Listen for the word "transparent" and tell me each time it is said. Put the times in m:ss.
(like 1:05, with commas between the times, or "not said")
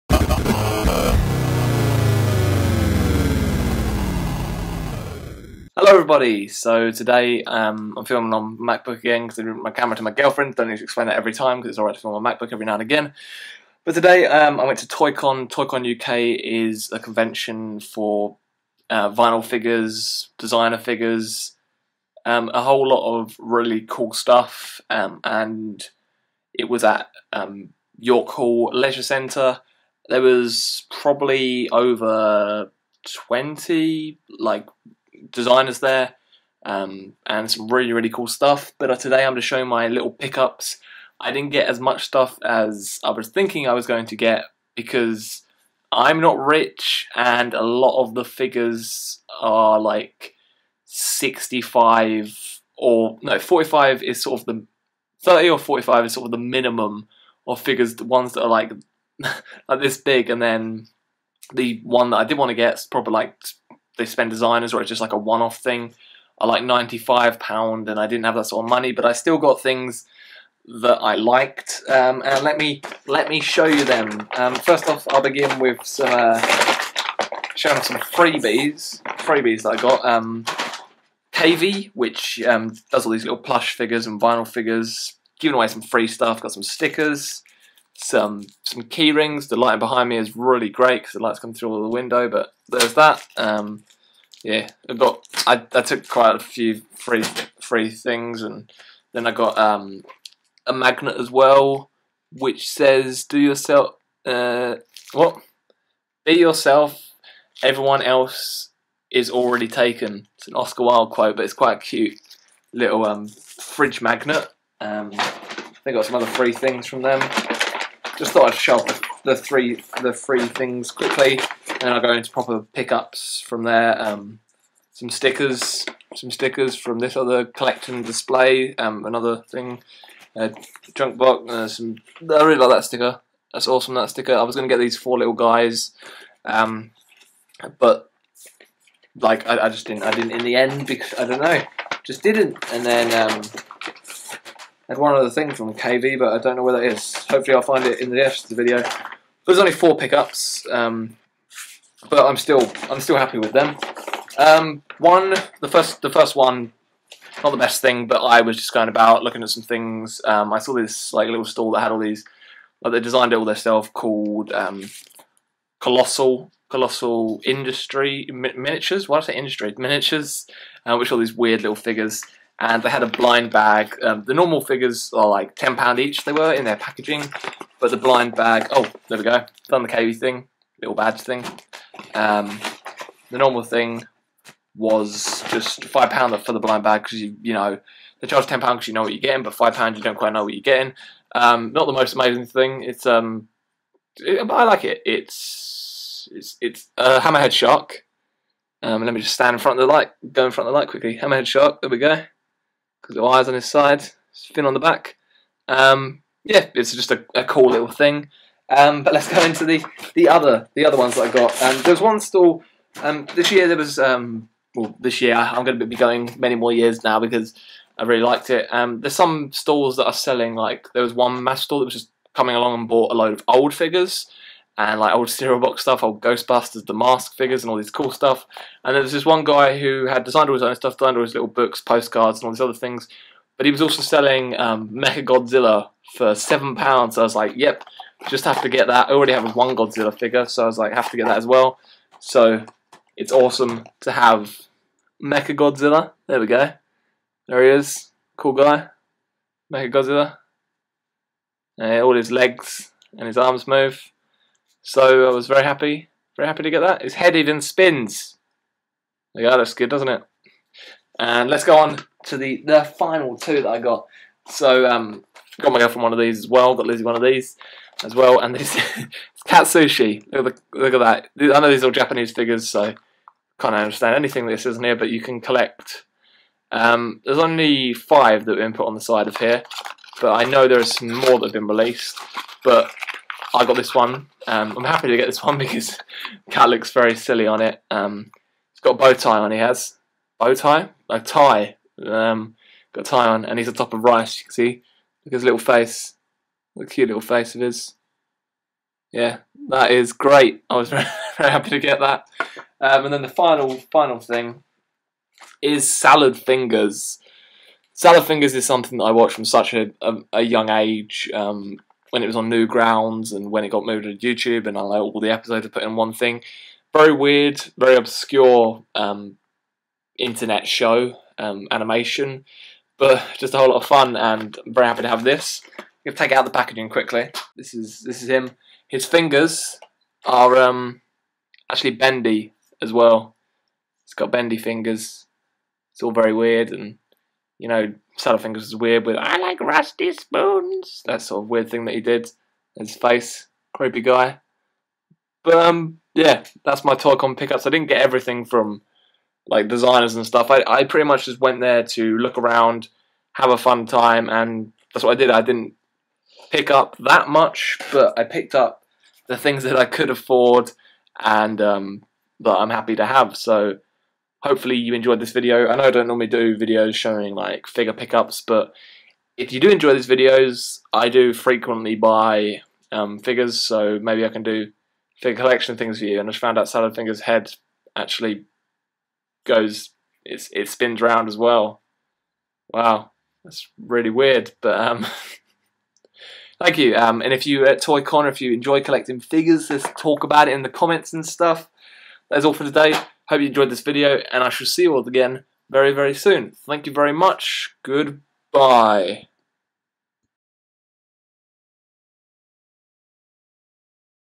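not said.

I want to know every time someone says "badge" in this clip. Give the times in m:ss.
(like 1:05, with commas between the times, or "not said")
3:00.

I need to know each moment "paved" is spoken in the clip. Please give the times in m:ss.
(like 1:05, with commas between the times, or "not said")
not said.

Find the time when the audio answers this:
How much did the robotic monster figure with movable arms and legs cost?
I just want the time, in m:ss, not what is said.
3:56.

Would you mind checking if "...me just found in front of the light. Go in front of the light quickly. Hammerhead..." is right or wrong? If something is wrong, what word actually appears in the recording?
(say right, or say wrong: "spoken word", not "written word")
wrong: "stand", not "found".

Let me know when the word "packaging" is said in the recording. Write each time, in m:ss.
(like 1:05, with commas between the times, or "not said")
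2:56, 5:26.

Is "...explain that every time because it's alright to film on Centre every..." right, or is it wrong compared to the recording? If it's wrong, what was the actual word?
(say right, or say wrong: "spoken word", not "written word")
wrong: "MacBook", not "Centre".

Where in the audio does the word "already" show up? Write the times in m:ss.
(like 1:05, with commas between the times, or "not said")
1:49, 3:59.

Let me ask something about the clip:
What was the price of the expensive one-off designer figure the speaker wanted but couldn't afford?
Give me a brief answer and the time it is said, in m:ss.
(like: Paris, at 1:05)
95 pounds, at 1:06.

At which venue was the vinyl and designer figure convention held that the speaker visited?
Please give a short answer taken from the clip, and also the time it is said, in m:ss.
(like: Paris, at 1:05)
York Hall Leisure Centre, at 0:27.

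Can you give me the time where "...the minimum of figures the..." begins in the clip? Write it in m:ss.
0:56.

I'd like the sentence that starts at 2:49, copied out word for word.
What did I say industry miniatures?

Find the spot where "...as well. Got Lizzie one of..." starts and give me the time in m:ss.
4:26.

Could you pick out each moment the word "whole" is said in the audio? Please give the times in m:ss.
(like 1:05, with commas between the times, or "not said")
0:22, 5:23.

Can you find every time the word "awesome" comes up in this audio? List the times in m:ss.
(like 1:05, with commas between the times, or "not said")
2:13, 4:03.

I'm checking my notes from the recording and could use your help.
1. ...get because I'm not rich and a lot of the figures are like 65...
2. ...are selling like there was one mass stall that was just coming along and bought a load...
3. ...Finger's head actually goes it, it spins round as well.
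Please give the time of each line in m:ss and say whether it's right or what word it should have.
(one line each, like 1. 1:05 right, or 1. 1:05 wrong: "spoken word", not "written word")
1. 0:44 right
2. 3:40 right
3. 6:16 right.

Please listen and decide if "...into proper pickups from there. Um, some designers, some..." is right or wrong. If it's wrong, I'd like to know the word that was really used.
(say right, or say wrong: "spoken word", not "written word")
wrong: "stickers", not "designers".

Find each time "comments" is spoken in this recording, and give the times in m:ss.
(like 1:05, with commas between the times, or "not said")
6:30.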